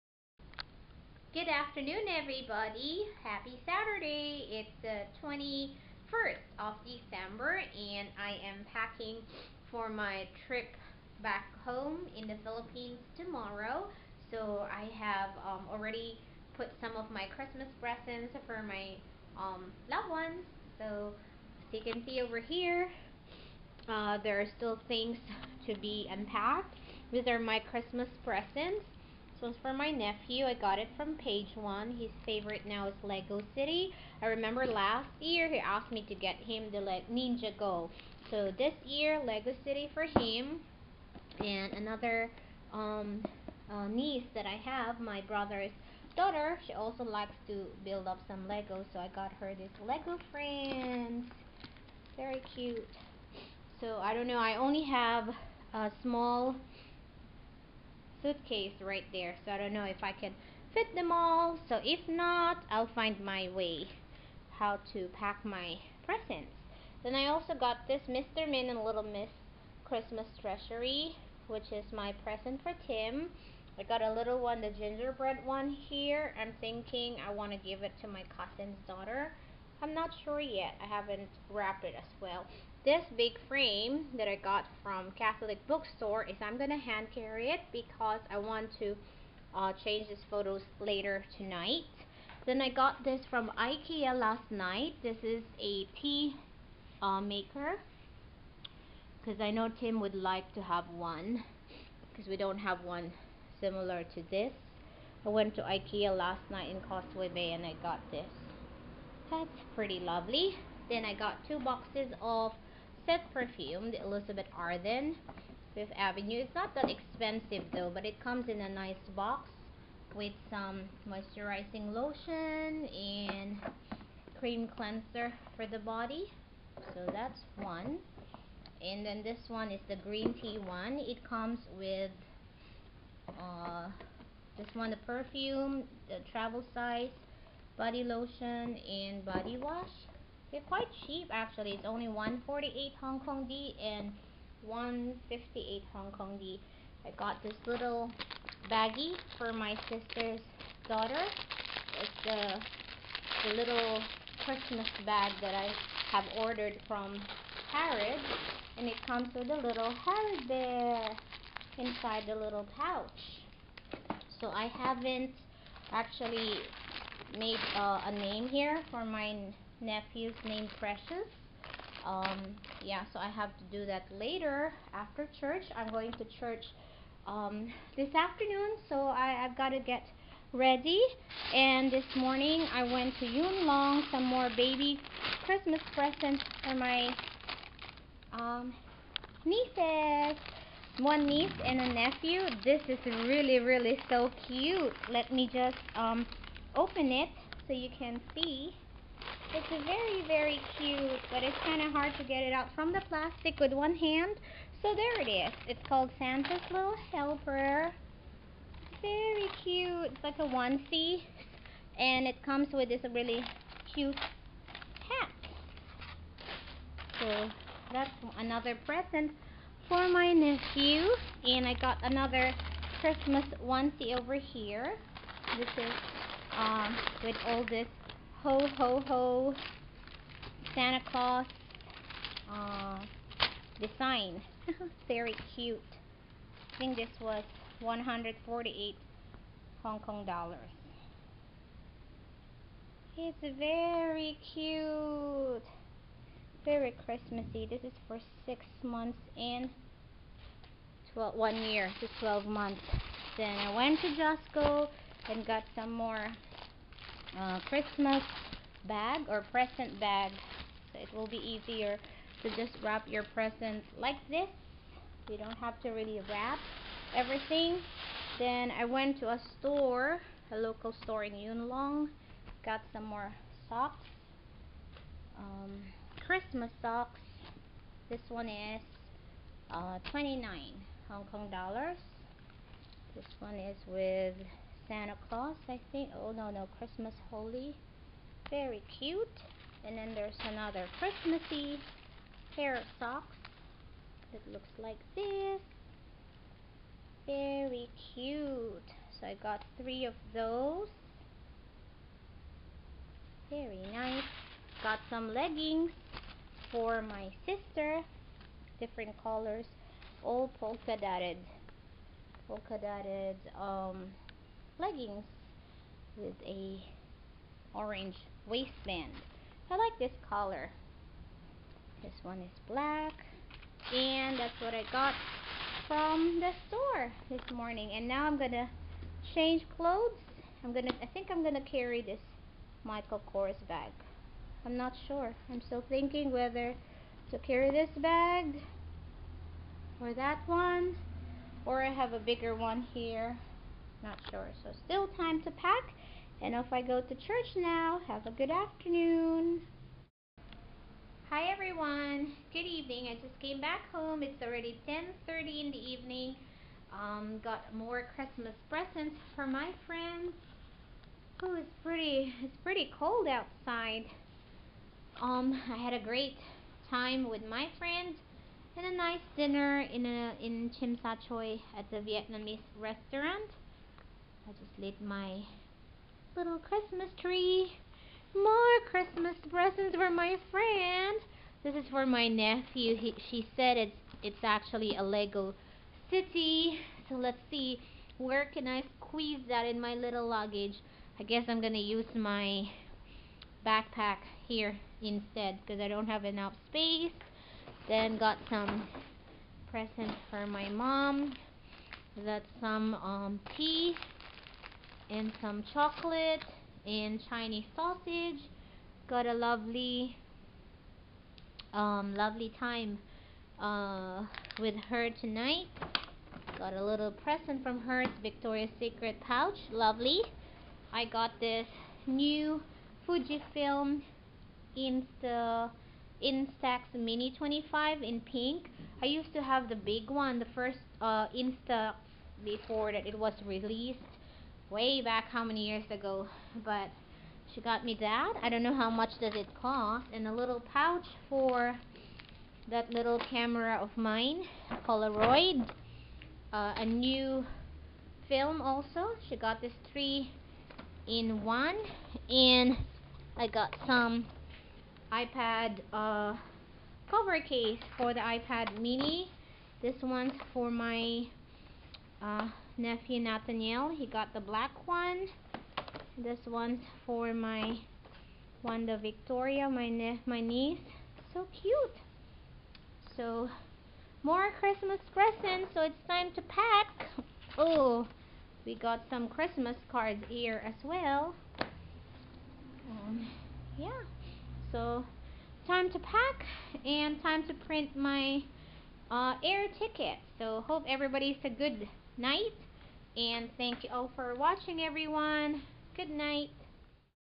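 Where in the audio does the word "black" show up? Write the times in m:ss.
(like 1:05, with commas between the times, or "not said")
5:22, 7:44.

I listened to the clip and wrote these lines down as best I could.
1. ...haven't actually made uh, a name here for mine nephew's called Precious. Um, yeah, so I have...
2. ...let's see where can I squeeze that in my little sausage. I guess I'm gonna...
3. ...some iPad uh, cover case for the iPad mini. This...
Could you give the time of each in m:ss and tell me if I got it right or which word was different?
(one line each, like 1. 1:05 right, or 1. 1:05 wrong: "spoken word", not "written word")
1. 2:44 wrong: "named", not "called"
2. 6:27 wrong: "luggage", not "sausage"
3. 7:33 right.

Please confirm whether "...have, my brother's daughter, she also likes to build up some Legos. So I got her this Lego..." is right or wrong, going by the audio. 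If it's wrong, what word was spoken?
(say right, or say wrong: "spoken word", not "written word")
right.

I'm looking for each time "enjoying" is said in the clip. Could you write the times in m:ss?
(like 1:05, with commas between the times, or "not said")
not said.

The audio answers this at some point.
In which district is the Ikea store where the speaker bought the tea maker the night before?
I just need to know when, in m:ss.
1:46.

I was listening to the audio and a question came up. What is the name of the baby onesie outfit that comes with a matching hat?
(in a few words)
Santa's Little Helper.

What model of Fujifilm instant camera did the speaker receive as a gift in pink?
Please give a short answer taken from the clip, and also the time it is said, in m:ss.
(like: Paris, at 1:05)
Instax Mini 25, at 7:06.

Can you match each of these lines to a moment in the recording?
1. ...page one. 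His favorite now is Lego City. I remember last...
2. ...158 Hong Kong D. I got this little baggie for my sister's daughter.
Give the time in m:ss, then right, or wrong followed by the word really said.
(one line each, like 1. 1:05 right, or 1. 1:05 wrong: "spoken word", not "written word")
1. 0:31 right
2. 2:24 right.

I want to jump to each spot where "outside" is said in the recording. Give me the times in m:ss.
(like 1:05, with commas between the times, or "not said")
6:03.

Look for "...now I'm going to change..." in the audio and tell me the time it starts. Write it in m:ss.
5:28.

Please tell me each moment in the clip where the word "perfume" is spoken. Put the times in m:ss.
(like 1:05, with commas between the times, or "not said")
1:53, 2:14.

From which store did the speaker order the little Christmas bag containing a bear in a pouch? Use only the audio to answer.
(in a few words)
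Harrods.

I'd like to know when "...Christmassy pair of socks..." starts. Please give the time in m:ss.
4:50.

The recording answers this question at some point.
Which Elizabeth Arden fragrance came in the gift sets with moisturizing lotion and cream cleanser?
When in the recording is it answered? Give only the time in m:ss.
1:55.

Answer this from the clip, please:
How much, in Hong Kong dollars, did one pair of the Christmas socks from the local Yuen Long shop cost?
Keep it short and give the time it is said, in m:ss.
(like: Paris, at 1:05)
29 Hong Kong dollars, at 4:40.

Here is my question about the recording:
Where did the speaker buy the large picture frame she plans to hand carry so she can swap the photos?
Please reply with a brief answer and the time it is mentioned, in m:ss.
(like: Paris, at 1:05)
Catholic bookstore, at 1:25.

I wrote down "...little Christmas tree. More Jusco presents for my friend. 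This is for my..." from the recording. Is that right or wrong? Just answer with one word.
wrong.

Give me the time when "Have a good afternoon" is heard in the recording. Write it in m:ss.
5:48.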